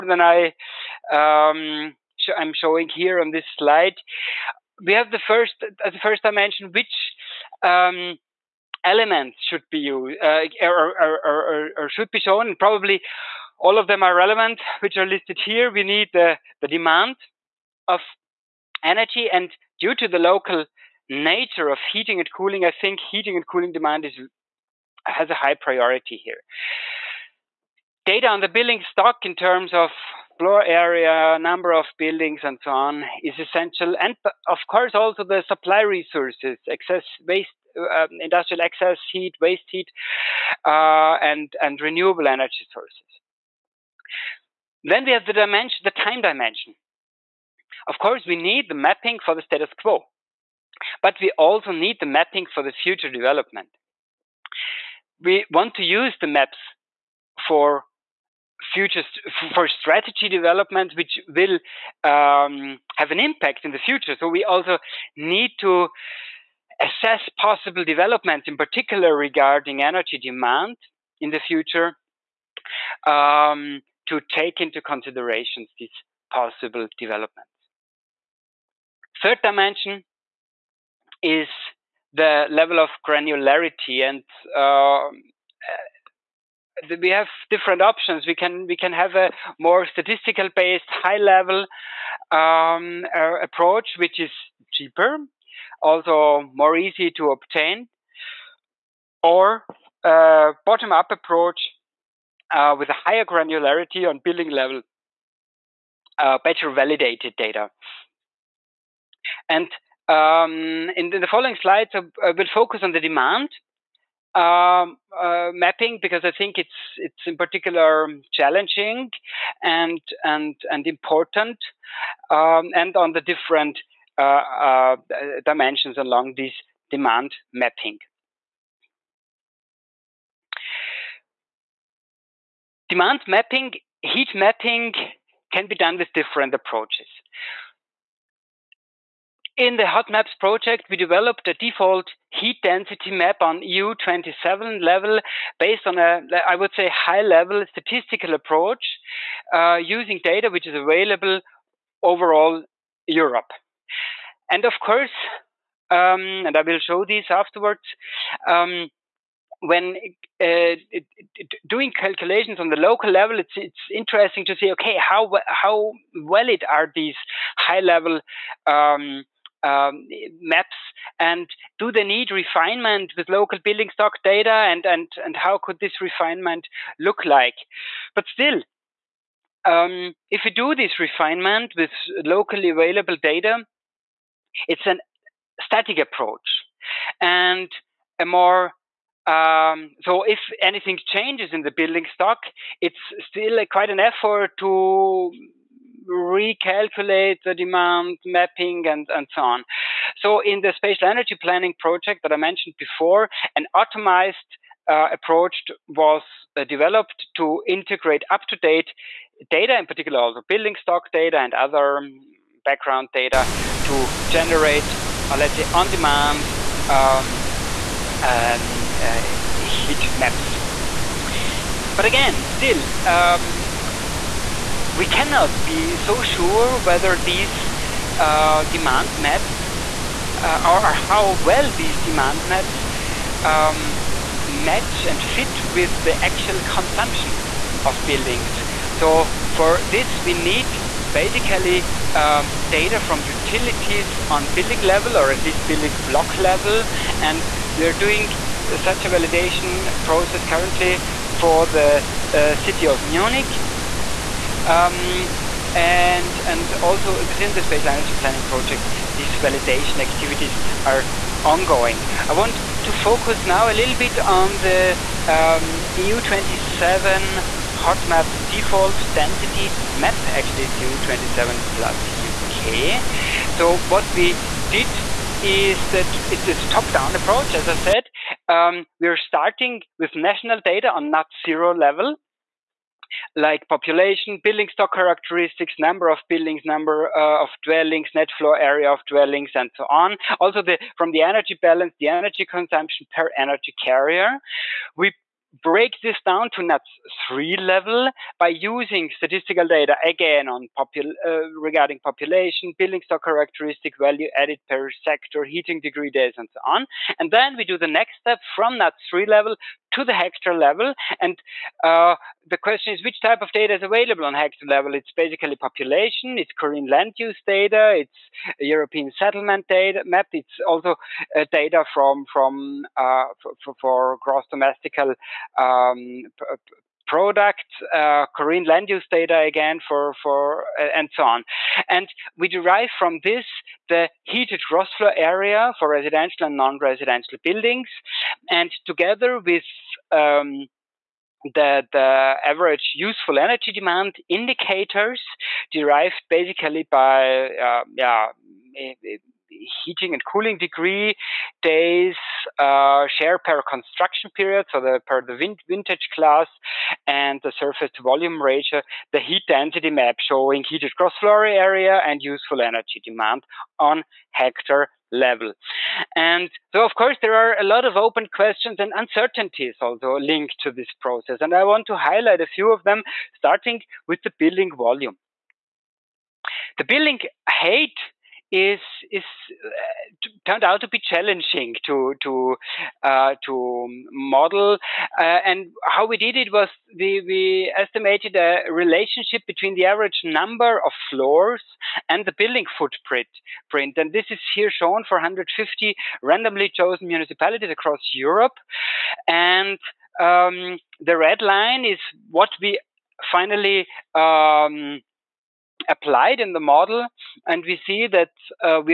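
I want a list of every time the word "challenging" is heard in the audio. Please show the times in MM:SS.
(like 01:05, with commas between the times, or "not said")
01:58, 06:21.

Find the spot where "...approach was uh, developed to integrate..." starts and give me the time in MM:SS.
03:25.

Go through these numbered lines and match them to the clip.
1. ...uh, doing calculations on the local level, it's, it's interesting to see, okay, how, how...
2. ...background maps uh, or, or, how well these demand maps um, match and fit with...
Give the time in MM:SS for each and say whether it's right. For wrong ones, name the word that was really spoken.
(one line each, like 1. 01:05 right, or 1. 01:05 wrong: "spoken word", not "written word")
1. 02:40 right
2. 03:48 wrong: "demand", not "background".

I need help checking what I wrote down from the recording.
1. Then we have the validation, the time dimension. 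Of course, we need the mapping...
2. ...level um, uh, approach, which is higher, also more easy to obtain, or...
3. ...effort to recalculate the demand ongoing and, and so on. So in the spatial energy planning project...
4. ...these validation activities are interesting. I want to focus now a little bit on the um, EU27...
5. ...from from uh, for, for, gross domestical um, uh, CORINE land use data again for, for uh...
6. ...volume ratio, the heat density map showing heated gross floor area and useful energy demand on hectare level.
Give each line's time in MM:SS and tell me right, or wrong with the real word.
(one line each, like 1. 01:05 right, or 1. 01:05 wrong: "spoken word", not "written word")
1. 00:44 wrong: "dimension", not "validation"
2. 01:31 wrong: "cheaper", not "higher"
3. 03:13 wrong: "mapping", not "ongoing"
4. 04:19 wrong: "ongoing", not "interesting"
5. 05:21 right
6. 05:58 right.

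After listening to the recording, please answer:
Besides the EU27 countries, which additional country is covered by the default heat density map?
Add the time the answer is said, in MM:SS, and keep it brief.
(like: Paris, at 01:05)
UK, at 04:32.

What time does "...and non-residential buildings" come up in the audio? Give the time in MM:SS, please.
05:36.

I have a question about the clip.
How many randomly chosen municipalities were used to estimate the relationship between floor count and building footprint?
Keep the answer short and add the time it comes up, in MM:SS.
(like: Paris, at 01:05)
150, at 06:35.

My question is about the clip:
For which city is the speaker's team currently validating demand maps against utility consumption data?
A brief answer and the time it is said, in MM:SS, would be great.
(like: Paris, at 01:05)
Munich, at 04:12.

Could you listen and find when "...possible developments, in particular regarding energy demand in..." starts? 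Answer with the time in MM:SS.
01:07.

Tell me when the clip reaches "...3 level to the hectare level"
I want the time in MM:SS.
05:09.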